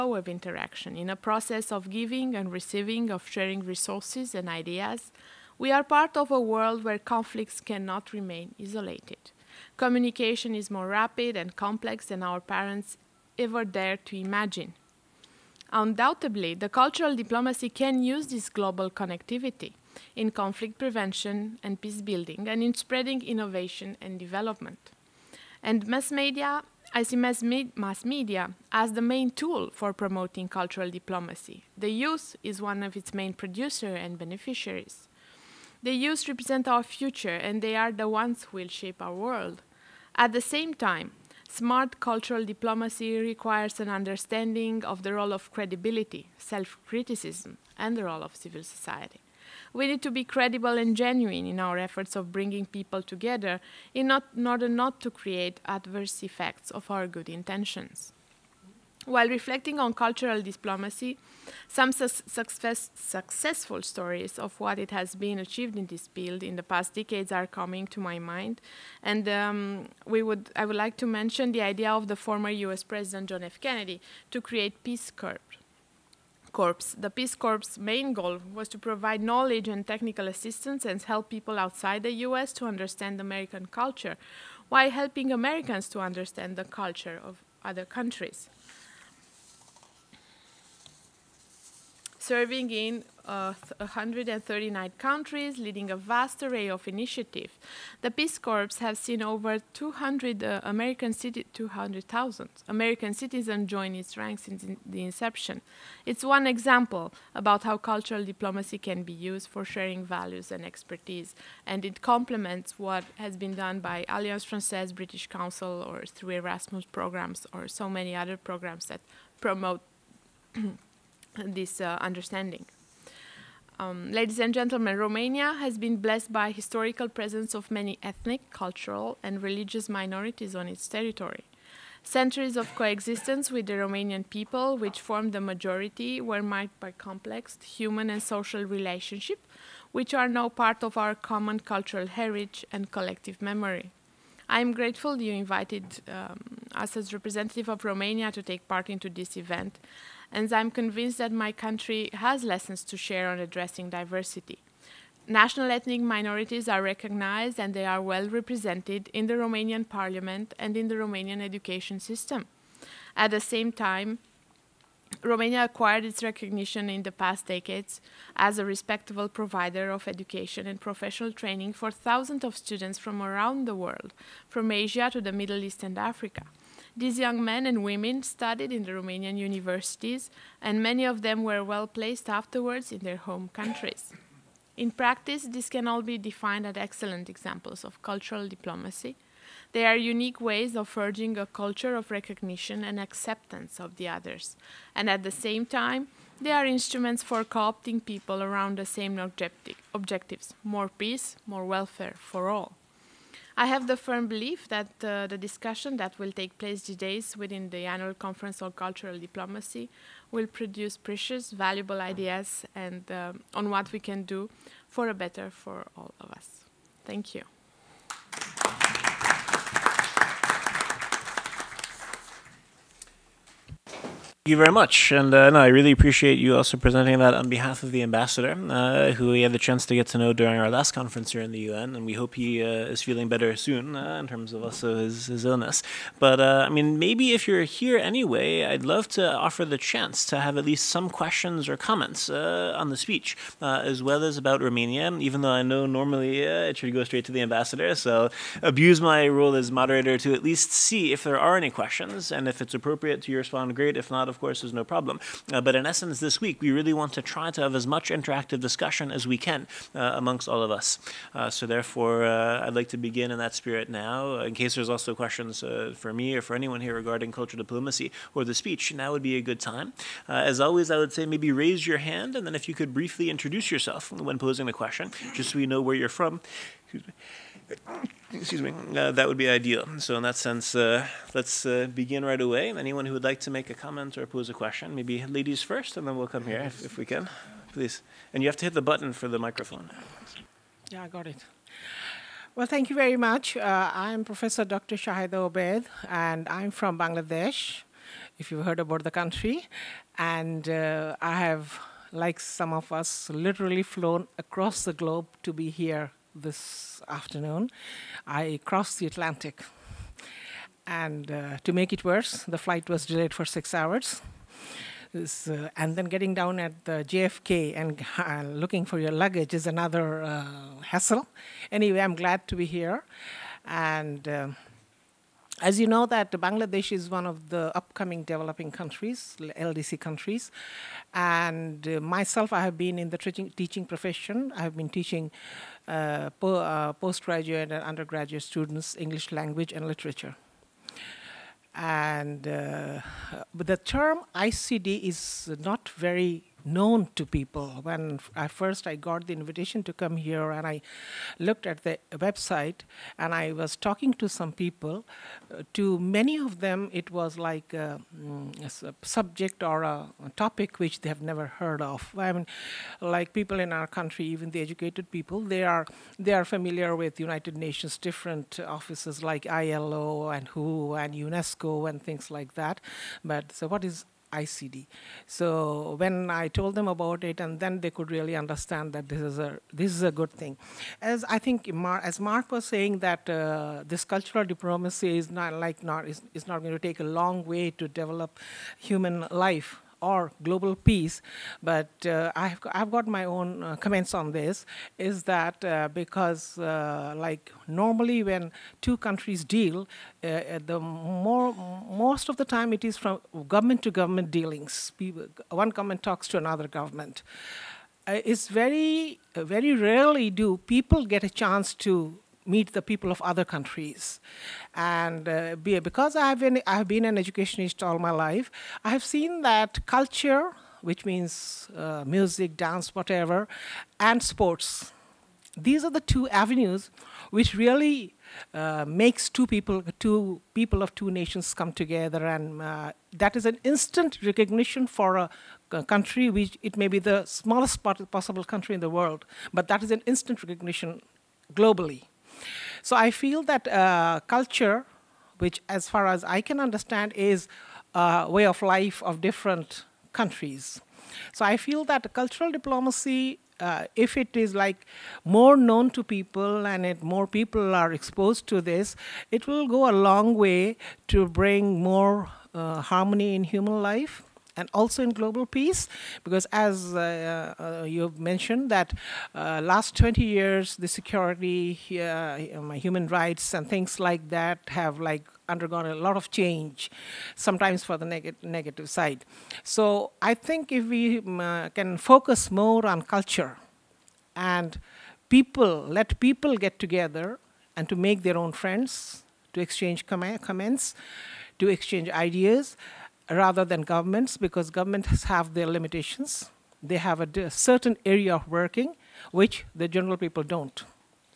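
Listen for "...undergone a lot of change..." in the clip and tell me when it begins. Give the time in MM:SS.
07:55.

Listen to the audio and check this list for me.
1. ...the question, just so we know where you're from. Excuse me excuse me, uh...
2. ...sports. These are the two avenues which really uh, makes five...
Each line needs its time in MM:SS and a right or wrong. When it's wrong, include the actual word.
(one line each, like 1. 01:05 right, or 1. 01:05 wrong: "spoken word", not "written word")
1. 04:34 right
2. 07:04 wrong: "two", not "five".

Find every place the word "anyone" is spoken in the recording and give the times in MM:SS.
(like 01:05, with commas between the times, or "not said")
04:26, 04:42.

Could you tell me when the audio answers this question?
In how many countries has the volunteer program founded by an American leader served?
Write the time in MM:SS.
01:33.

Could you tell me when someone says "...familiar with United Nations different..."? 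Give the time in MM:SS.
06:06.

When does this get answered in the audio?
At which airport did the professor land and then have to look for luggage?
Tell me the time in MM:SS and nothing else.
05:17.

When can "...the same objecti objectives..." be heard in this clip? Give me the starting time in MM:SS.
03:18.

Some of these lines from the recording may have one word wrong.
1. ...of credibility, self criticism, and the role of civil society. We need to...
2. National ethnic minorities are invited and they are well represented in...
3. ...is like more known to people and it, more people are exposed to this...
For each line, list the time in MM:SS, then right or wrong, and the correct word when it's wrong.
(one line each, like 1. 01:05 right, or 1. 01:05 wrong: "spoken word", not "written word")
1. 00:45 right
2. 02:35 wrong: "recognized", not "invited"
3. 07:34 right.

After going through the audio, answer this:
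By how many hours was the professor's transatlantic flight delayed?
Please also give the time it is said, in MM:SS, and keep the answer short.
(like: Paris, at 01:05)
6, at 05:13.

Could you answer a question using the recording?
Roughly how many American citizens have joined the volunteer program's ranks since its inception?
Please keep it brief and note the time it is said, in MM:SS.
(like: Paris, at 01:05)
200,000, at 01:41.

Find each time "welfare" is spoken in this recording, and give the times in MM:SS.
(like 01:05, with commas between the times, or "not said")
03:21.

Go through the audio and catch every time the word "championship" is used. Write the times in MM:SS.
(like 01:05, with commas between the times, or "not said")
not said.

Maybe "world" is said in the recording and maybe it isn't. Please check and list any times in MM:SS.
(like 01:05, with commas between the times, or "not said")
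00:06, 00:39, 02:53, 07:18.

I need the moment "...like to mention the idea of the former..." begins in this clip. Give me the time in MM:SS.
01:10.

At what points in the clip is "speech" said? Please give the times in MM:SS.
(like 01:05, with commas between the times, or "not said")
04:02, 04:28.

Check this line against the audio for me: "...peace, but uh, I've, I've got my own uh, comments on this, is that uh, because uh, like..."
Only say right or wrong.
right.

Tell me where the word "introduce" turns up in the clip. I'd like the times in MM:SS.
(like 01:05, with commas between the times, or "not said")
04:33.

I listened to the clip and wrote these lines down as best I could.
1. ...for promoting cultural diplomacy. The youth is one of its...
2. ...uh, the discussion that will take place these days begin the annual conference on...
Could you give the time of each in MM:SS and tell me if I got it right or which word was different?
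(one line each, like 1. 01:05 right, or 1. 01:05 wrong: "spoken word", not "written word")
1. 00:29 right
2. 03:25 wrong: "within", not "begin".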